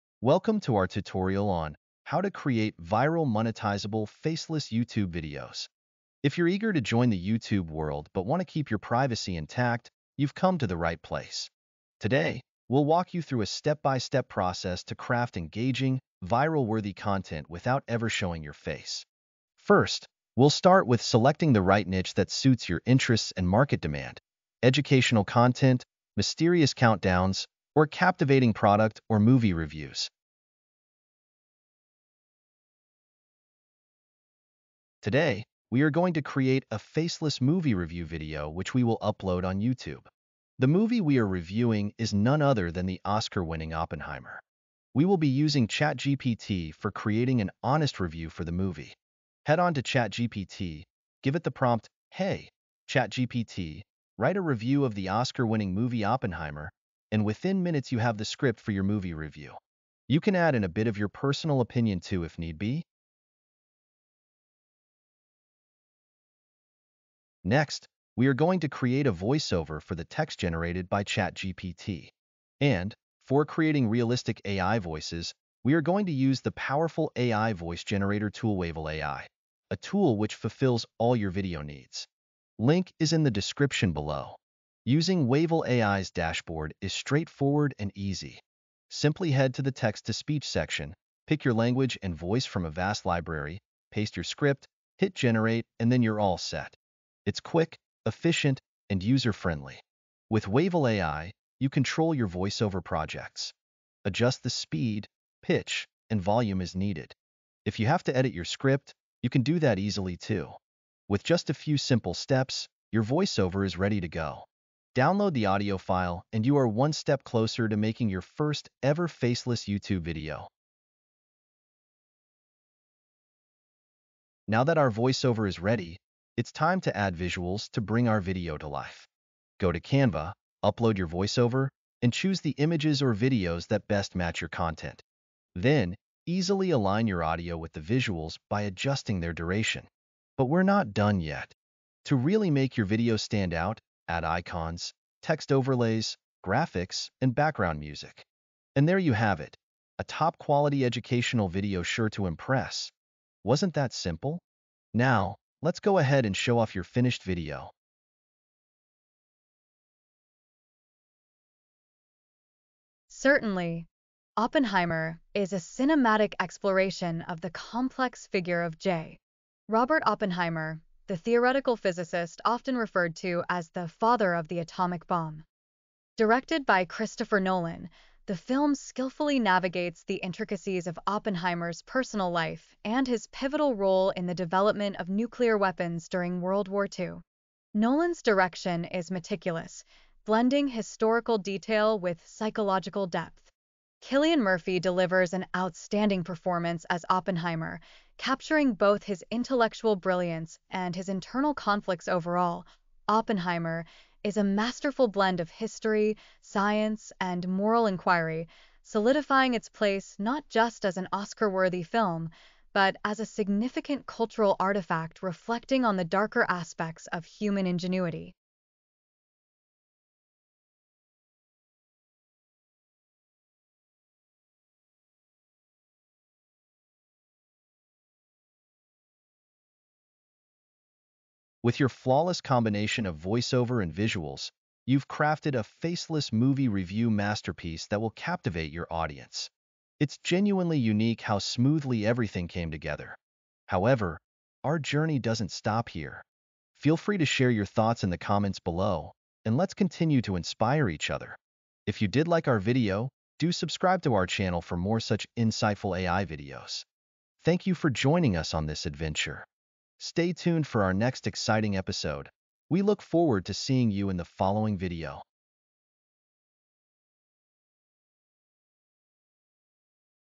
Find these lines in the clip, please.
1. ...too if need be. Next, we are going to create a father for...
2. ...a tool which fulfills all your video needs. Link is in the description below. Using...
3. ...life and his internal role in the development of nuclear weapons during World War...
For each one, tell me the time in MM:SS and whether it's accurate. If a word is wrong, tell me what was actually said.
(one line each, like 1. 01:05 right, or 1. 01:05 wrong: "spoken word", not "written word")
1. 01:01 wrong: "voiceover", not "father"
2. 01:19 right
3. 03:02 wrong: "pivotal", not "internal".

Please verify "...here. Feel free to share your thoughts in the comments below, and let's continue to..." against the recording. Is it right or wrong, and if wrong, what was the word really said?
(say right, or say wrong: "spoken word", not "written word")
right.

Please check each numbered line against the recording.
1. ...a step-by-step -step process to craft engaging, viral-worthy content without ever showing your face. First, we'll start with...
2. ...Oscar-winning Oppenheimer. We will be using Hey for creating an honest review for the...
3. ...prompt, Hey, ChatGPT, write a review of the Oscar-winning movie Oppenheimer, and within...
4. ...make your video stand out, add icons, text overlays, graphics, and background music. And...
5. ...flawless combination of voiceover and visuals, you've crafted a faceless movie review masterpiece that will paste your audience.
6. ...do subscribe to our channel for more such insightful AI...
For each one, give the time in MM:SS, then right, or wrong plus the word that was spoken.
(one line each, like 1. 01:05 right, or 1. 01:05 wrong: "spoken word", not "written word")
1. 00:13 right
2. 00:43 wrong: "ChatGPT", not "Hey"
3. 00:51 right
4. 02:22 right
5. 03:51 wrong: "captivate", not "paste"
6. 04:13 right.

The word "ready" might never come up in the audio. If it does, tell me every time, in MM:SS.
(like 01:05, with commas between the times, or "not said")
01:53, 02:05.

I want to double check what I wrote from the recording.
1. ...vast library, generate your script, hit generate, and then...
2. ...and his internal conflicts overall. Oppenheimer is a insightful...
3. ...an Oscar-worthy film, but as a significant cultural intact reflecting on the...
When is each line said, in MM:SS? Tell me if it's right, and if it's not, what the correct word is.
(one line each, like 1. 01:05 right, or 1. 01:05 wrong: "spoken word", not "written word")
1. 01:32 wrong: "paste", not "generate"
2. 03:20 wrong: "masterful", not "insightful"
3. 03:30 wrong: "artifact", not "intact".